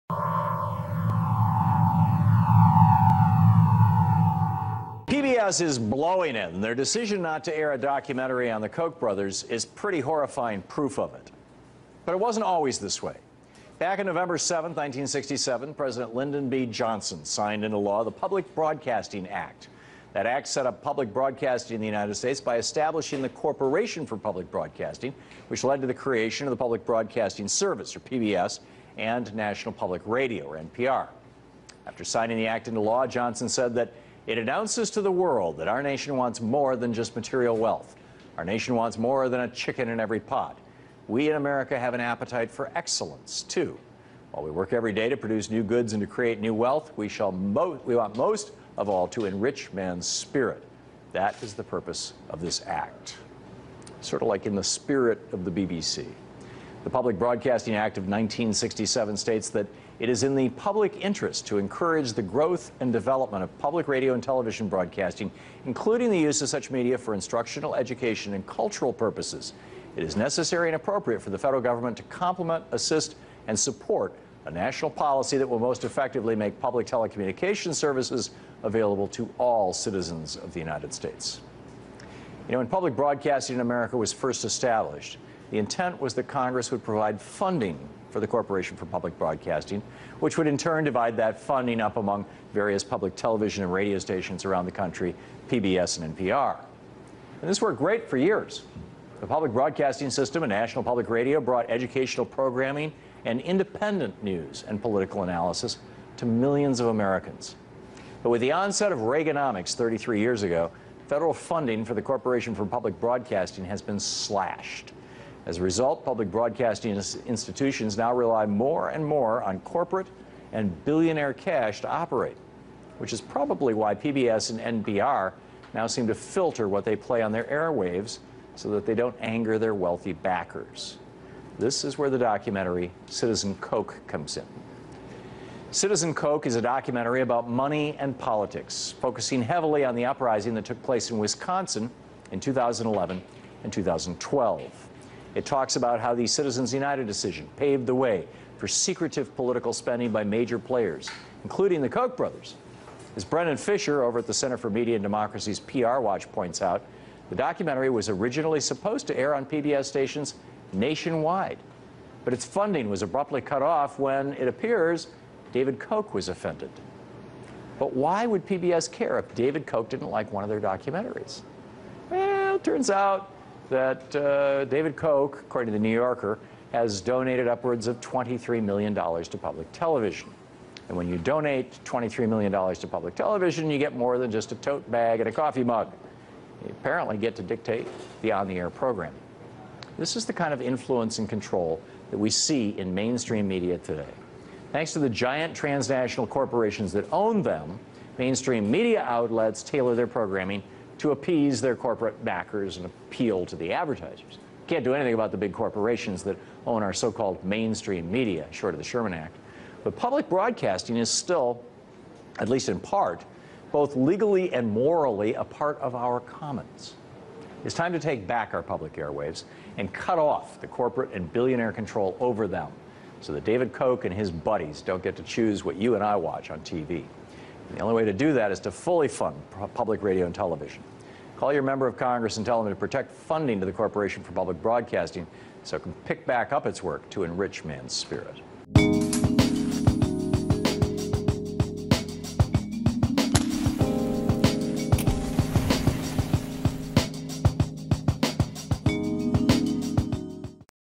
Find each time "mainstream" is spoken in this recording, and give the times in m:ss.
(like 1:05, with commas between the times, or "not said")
3:12, 3:18, 3:27.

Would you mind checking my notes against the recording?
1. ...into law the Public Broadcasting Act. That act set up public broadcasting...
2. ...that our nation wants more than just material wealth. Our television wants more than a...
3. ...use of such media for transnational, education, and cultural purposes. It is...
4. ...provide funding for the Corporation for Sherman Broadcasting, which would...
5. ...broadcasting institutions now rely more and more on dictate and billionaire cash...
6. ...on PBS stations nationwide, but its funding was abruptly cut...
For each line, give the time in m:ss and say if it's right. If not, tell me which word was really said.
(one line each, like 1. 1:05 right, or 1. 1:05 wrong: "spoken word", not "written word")
1. 0:17 right
2. 0:35 wrong: "nation", not "television"
3. 1:06 wrong: "instructional", not "transnational"
4. 1:26 wrong: "Public", not "Sherman"
5. 1:56 wrong: "corporate", not "dictate"
6. 2:39 right.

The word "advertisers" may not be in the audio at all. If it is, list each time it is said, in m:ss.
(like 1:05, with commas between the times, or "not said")
3:23.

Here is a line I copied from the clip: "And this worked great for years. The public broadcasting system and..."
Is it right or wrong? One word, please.
right.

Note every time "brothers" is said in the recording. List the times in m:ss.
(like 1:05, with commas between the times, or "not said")
0:08, 2:32.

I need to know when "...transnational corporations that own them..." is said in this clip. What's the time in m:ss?
3:15.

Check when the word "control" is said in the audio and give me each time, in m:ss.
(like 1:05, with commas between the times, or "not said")
3:11, 3:41.